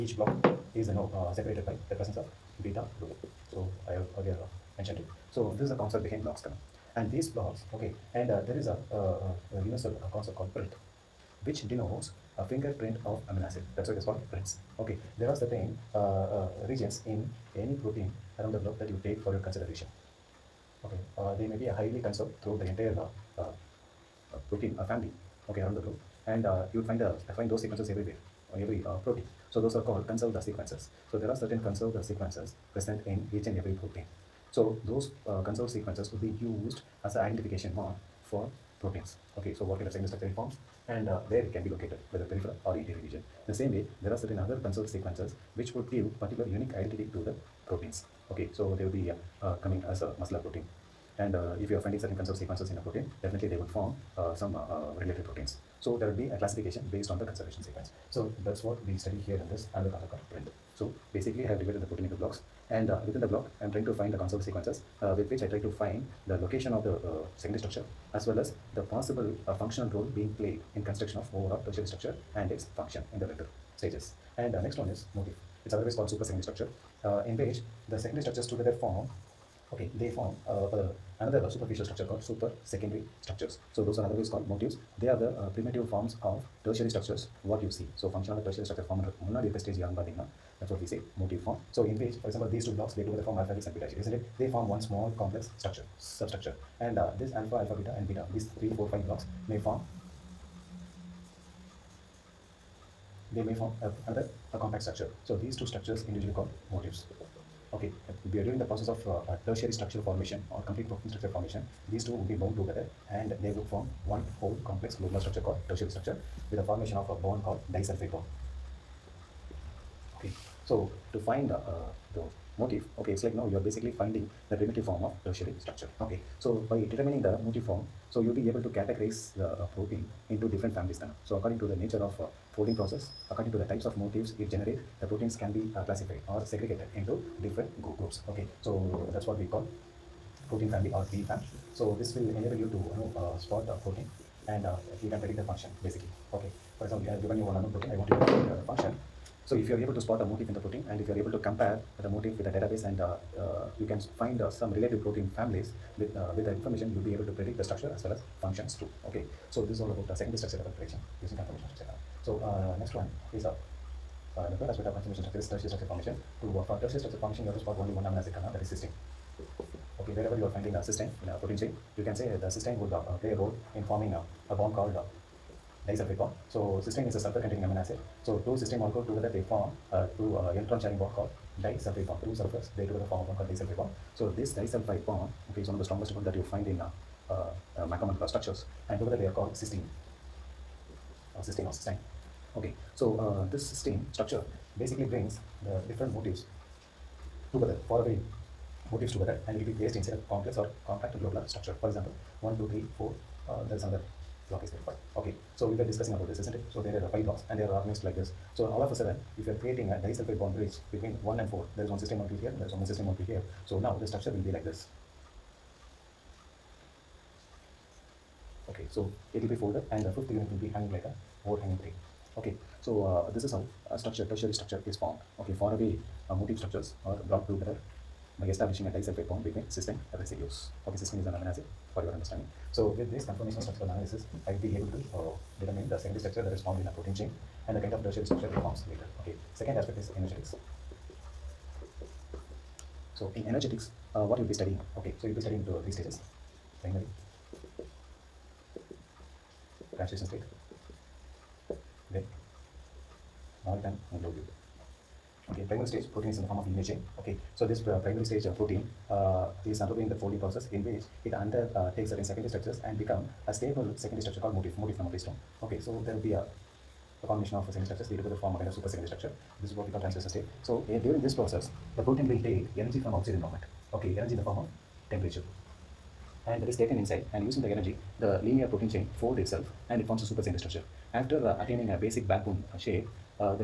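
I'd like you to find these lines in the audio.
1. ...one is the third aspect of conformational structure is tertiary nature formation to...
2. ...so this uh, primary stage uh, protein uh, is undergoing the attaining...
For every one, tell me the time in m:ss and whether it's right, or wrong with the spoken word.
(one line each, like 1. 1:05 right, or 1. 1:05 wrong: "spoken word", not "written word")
1. 2:42 wrong: "structure", not "nature"
2. 4:17 wrong: "folding", not "attaining".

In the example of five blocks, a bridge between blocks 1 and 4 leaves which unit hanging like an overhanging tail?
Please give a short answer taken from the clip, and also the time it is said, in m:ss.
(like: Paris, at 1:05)
The fifth unit, at 3:40.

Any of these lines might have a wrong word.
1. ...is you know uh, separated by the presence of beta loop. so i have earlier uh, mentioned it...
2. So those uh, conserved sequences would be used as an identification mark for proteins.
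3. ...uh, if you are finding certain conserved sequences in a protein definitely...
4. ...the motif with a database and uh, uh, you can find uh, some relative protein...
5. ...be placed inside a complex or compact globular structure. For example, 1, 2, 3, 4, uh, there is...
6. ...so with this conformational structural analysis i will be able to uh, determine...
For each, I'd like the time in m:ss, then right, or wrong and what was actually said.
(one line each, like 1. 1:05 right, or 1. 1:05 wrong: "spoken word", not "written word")
1. 0:00 right
2. 0:34 right
3. 0:51 right
4. 2:32 right
5. 3:19 right
6. 3:52 right.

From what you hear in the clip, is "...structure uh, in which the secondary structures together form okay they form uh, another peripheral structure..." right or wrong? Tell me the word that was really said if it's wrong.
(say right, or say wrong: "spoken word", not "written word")
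wrong: "superficial", not "peripheral".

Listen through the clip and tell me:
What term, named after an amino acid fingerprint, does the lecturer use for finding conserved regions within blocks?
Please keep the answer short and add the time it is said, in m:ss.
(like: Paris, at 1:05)
Prints, at 0:14.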